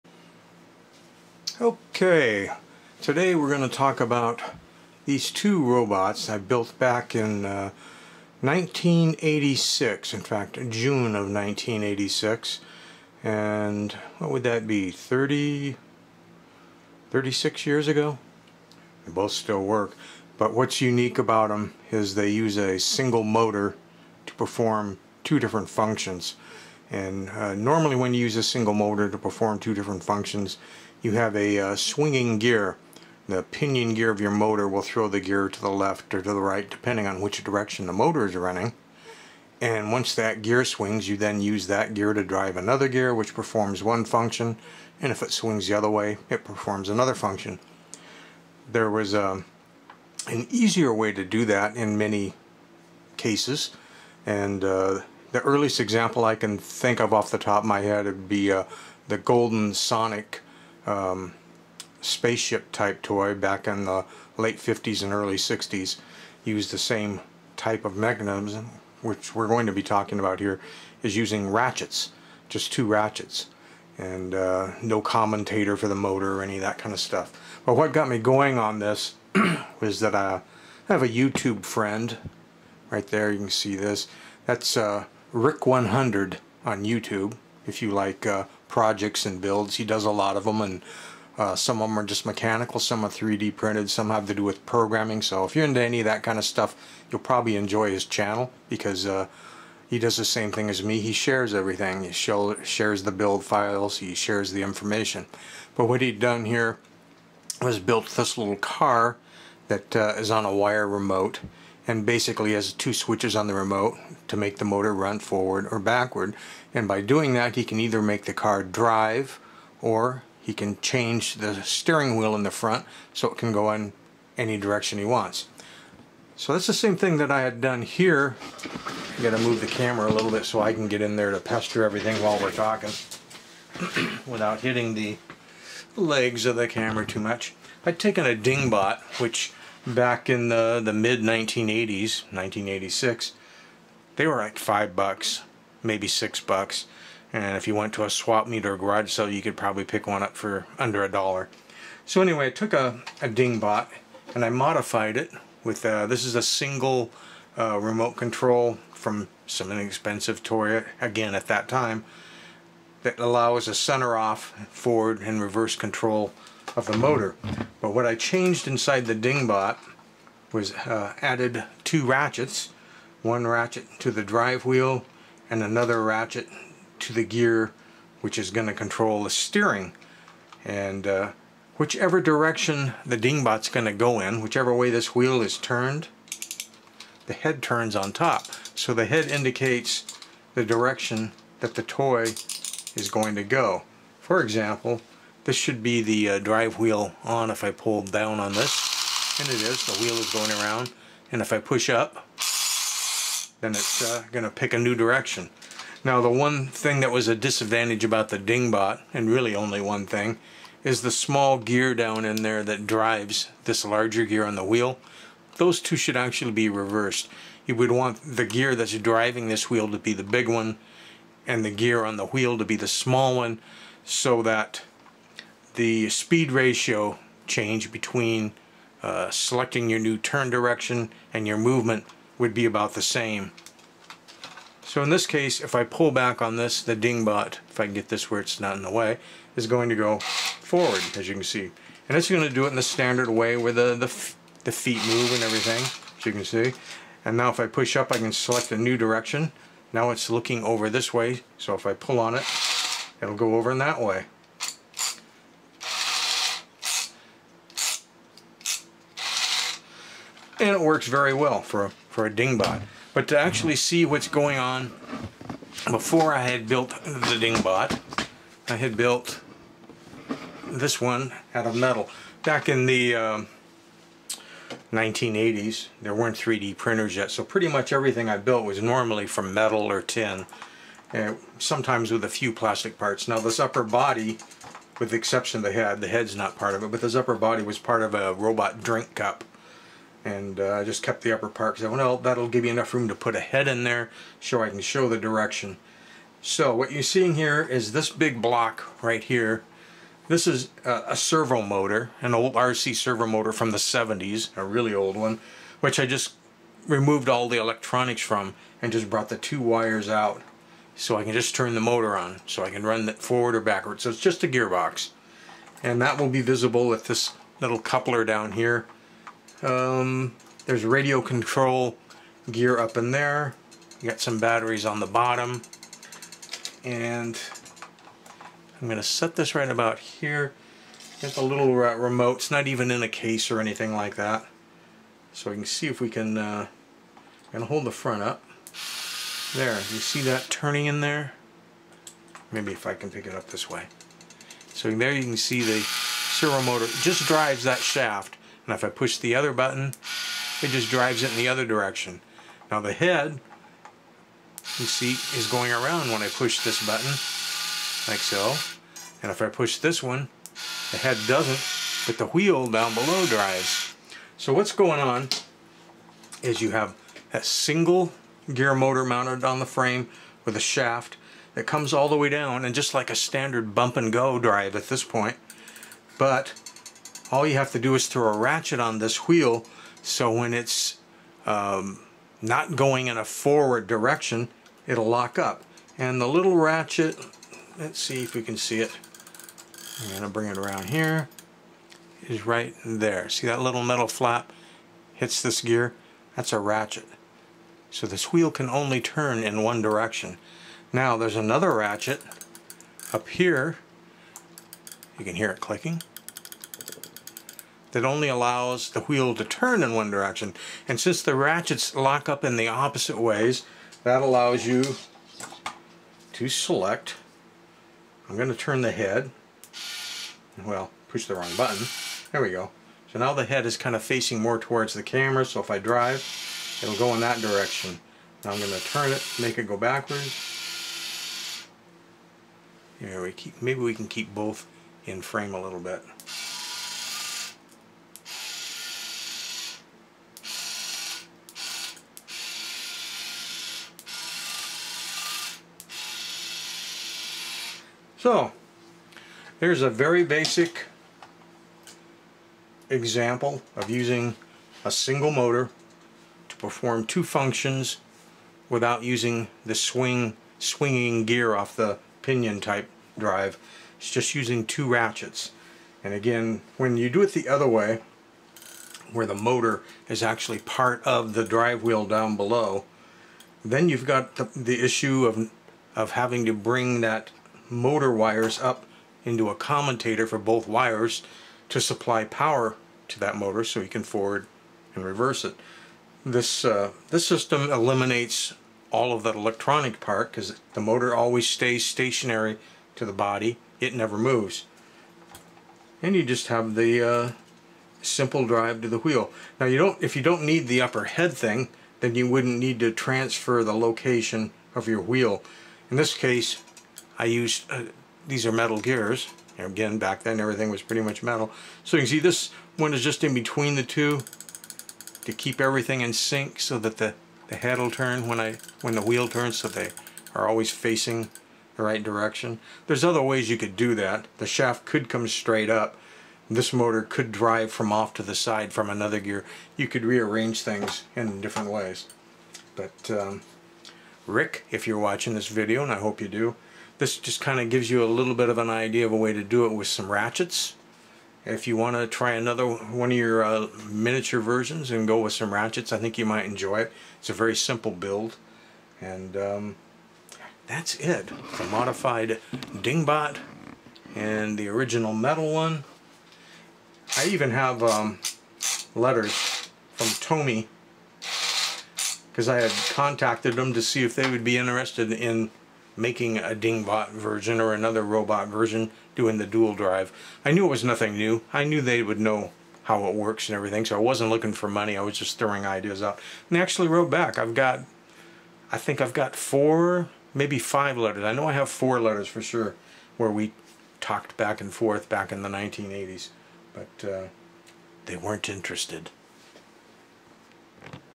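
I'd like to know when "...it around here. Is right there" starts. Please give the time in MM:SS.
06:30.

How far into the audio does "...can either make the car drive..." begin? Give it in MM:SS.
01:57.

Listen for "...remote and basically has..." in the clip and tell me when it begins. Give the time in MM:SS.
01:50.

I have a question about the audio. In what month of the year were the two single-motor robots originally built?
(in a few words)
June.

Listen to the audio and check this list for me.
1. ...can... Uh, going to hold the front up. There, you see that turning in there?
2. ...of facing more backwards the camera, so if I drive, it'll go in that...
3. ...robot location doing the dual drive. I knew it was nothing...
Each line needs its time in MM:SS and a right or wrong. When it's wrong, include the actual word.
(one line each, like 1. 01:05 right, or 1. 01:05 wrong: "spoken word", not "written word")
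1. 05:36 right
2. 07:03 wrong: "towards", not "backwards"
3. 09:28 wrong: "version", not "location".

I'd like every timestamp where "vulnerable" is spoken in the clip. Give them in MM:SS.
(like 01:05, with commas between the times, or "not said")
not said.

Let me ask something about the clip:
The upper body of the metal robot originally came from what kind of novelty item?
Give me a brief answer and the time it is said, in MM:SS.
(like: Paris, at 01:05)
robot drink cup, at 04:48.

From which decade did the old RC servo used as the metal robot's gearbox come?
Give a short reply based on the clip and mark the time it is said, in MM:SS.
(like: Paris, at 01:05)
the 70s, at 05:03.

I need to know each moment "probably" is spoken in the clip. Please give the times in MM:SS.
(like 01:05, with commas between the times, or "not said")
01:37, 02:29.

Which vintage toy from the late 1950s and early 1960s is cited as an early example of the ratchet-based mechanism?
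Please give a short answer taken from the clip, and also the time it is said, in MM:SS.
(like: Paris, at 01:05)
Golden Sonic, at 00:59.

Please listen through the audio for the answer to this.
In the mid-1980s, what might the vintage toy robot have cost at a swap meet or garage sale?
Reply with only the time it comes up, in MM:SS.
02:30.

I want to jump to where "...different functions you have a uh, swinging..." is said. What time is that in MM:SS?
00:29.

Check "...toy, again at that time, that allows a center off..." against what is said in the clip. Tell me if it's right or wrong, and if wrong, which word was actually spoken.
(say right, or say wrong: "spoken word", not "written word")
right.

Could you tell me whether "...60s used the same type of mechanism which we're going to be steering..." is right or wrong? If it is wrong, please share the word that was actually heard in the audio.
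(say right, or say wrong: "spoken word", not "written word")
wrong: "talking", not "steering".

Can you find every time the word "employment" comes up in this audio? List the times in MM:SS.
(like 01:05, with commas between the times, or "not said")
not said.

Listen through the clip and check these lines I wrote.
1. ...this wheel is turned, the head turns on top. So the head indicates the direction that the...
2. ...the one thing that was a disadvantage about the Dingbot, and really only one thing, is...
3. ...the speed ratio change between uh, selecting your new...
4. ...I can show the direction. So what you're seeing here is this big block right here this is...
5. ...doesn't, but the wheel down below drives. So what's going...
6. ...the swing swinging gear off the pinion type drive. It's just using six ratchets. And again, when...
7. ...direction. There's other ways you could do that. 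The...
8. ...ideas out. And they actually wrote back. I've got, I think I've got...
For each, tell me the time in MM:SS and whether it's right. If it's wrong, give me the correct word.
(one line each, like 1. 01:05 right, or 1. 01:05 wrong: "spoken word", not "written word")
1. 03:04 right
2. 03:26 right
3. 03:45 right
4. 04:54 right
5. 06:01 right
6. 07:39 wrong: "two", not "six"
7. 08:42 right
8. 09:35 right.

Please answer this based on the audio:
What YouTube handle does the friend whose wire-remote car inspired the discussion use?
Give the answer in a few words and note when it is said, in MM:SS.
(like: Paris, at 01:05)
Rick 100, at 01:25.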